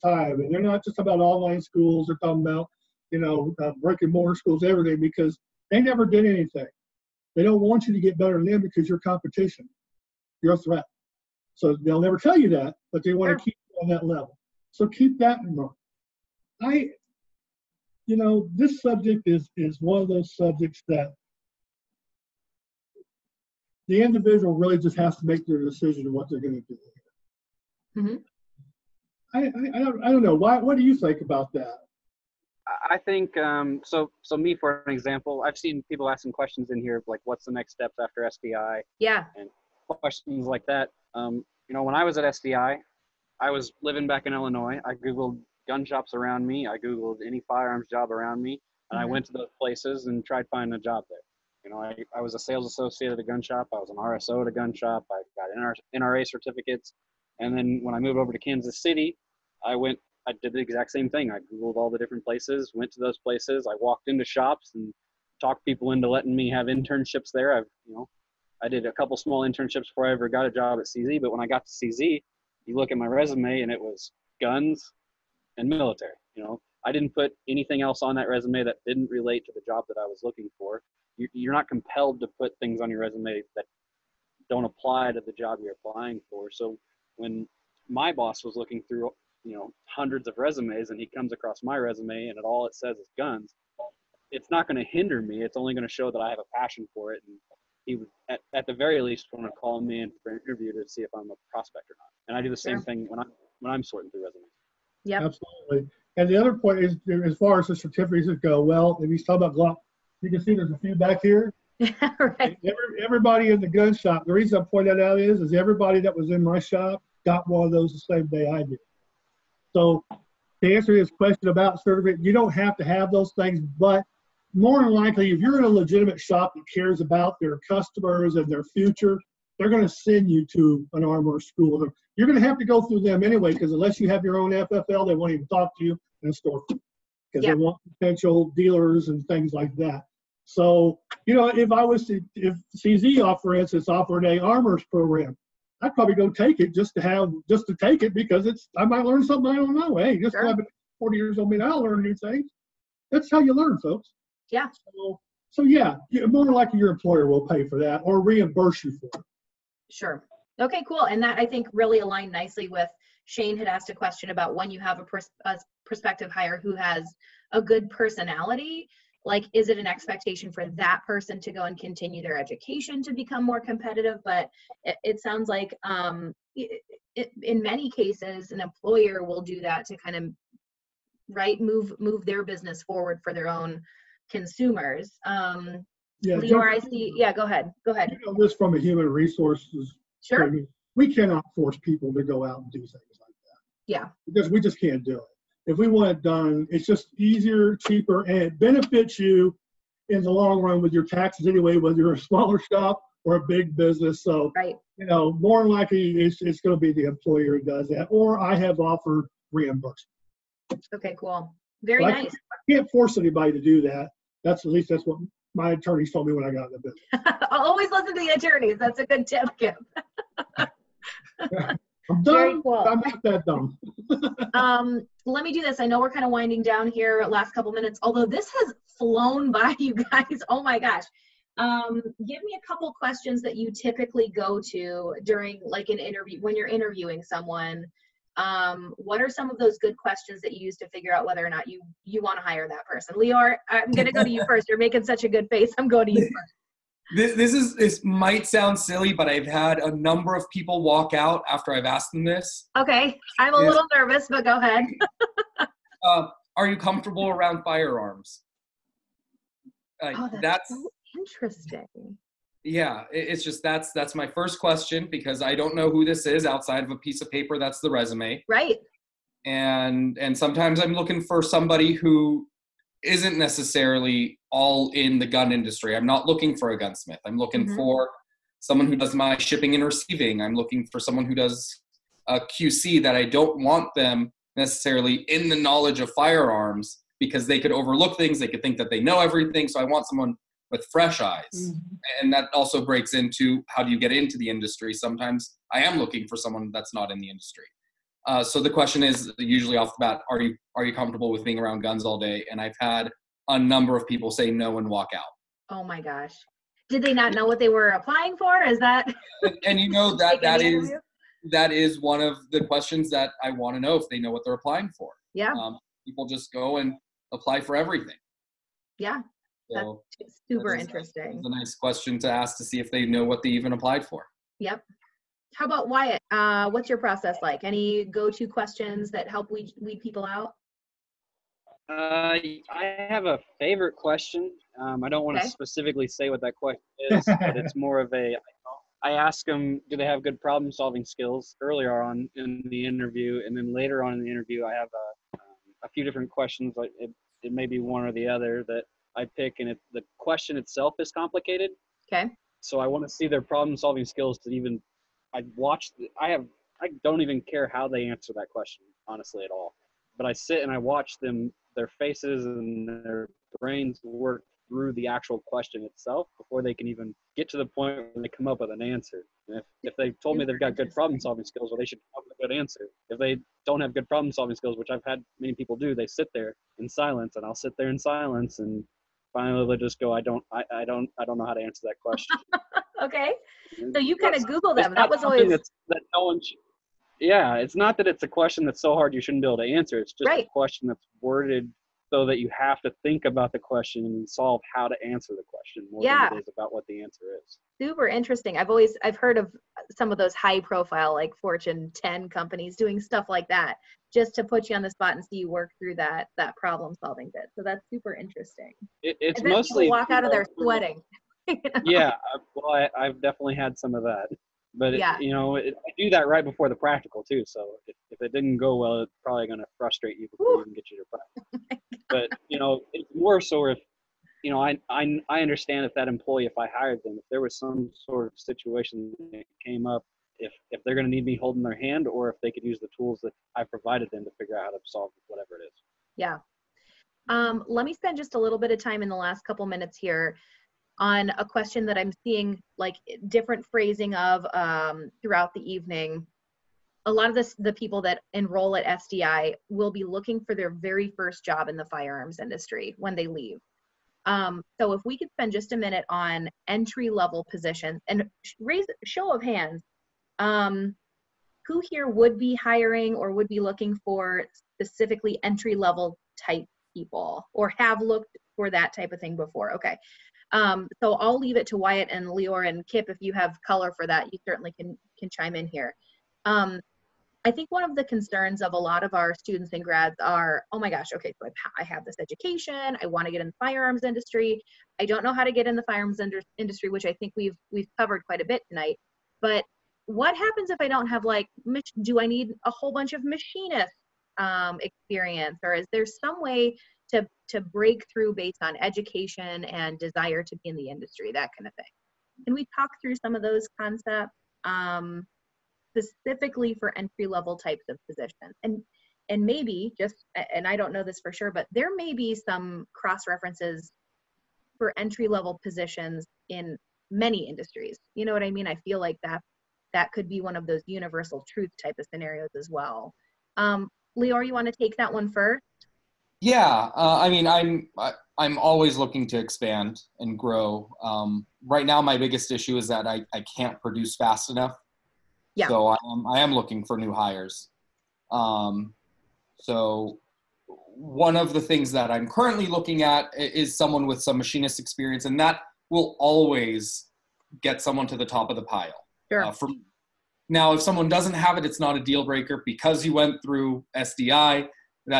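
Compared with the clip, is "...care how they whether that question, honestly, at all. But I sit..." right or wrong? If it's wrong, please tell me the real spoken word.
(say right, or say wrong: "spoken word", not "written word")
wrong: "answer", not "whether".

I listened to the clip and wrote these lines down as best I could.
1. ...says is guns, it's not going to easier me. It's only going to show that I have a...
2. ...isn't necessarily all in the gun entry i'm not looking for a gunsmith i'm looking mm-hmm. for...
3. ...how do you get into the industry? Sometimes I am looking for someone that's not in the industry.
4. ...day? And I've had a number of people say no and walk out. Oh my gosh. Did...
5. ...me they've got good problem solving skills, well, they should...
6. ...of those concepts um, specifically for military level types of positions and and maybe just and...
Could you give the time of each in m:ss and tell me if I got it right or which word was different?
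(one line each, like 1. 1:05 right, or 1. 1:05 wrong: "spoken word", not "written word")
1. 1:32 wrong: "hinder", not "easier"
2. 4:33 wrong: "industry", not "entry"
3. 4:53 right
4. 5:02 right
5. 6:10 right
6. 8:23 wrong: "entry", not "military".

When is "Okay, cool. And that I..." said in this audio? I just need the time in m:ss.
2:40.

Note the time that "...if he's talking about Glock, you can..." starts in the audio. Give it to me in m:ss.
1:49.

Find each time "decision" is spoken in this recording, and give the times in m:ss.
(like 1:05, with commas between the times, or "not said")
0:25.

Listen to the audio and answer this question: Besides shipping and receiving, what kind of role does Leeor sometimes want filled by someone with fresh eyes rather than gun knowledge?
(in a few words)
QC.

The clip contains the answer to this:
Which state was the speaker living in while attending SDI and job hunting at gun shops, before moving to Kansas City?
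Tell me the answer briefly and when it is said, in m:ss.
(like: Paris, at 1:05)
Illinois, at 0:44.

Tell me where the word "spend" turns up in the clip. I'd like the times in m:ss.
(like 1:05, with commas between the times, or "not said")
7:17, 7:35.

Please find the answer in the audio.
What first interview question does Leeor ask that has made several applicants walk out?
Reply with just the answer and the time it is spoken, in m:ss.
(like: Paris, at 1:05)
Are you comfortable around firearms, at 4:16.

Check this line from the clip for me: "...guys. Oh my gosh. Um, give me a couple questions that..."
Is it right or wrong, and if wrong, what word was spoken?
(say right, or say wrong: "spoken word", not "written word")
right.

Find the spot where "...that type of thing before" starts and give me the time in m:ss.
7:48.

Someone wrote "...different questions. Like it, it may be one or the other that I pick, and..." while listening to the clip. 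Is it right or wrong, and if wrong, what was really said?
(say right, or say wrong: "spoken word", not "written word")
right.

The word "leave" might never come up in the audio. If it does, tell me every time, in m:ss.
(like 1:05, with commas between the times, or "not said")
7:33, 7:51.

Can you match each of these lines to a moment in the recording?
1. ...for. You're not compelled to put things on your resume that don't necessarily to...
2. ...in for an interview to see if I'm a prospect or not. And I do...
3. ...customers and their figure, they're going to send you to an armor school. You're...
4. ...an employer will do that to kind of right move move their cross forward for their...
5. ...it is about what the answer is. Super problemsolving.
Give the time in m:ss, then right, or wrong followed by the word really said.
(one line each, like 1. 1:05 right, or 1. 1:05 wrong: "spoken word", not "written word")
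1. 1:20 wrong: "apply", not "necessarily"
2. 1:40 right
3. 2:07 wrong: "future", not "figure"
4. 2:58 wrong: "business", not "cross"
5. 6:36 wrong: "interesting", not "problemsolving".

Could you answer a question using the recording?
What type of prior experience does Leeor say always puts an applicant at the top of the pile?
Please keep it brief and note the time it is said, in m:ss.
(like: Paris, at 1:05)
machinist experience, at 9:04.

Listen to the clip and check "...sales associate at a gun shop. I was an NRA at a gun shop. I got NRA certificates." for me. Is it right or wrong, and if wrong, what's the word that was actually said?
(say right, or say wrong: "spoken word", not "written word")
wrong: "RSO", not "NRA".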